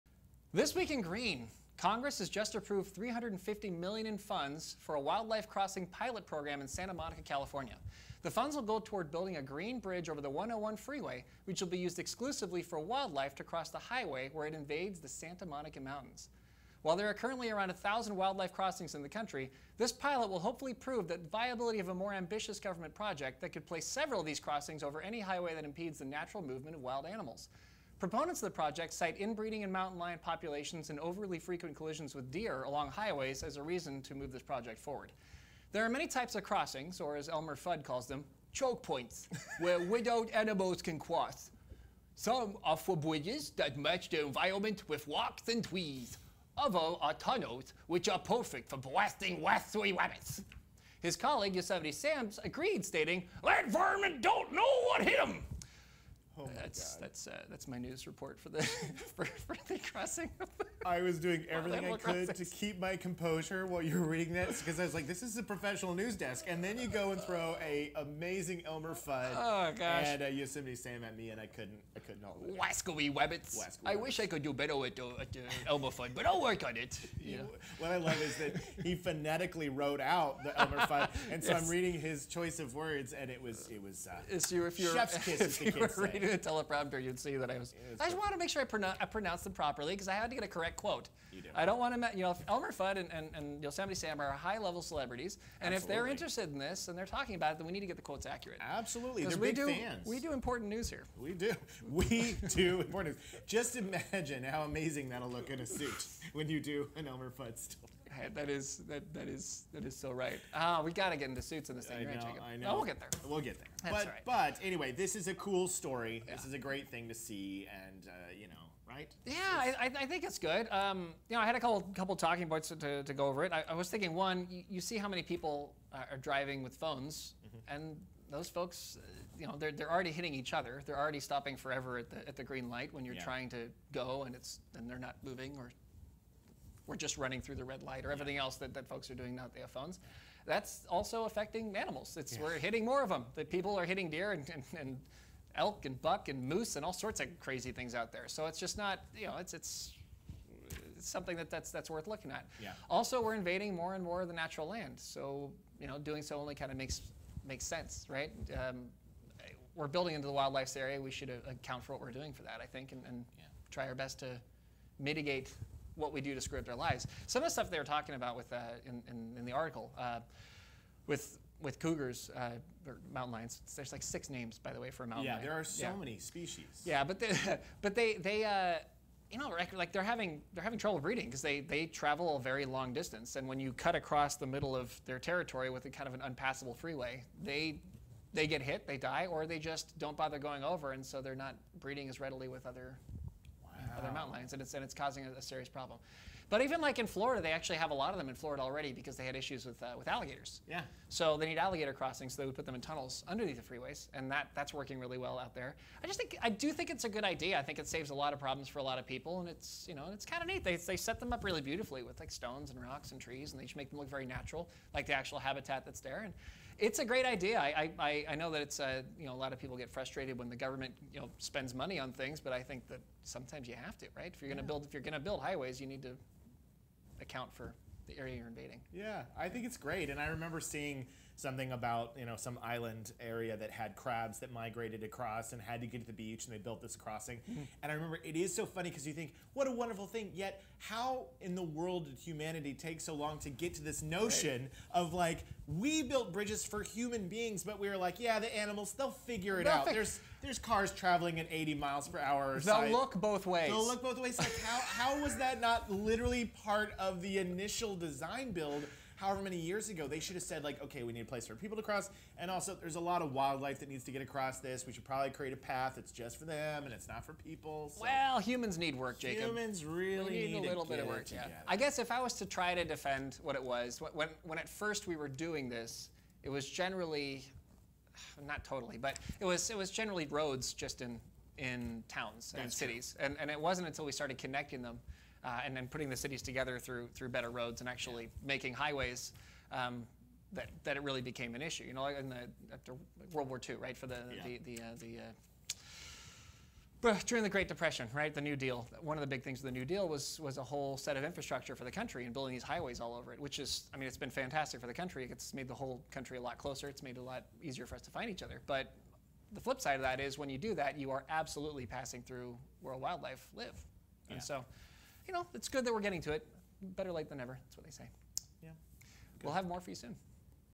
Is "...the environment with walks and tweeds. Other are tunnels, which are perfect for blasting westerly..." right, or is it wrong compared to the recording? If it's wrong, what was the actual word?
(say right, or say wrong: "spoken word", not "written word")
right.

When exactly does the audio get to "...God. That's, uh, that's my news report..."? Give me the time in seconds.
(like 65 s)
56 s.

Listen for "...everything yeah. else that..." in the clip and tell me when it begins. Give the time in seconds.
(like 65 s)
138 s.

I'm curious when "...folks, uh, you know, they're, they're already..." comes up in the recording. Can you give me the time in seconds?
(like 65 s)
128 s.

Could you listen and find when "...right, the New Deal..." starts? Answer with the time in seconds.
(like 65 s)
298 s.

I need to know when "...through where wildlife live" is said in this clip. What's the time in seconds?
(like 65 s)
312 s.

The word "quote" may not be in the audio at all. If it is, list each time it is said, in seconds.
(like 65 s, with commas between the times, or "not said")
90 s, 98 s.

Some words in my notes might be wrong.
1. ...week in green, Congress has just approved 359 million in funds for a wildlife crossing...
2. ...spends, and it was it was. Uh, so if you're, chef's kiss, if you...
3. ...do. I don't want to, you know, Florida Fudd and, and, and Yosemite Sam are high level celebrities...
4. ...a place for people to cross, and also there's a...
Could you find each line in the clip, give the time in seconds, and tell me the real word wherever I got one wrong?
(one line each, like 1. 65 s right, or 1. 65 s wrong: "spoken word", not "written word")
1. 0 s wrong: "350", not "359"
2. 82 s wrong: "words", not "spends"
3. 91 s wrong: "Elmer", not "Florida"
4. 261 s right.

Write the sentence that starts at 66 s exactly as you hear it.
And then you go and throw a amazing Elmer Fudd oh, gosh.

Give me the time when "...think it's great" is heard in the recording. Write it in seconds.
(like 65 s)
229 s.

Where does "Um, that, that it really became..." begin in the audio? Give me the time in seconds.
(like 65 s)
289 s.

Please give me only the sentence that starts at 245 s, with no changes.
of like, we built bridges for human beings, but we were like, yeah, the animals, they'll figure it Perfect.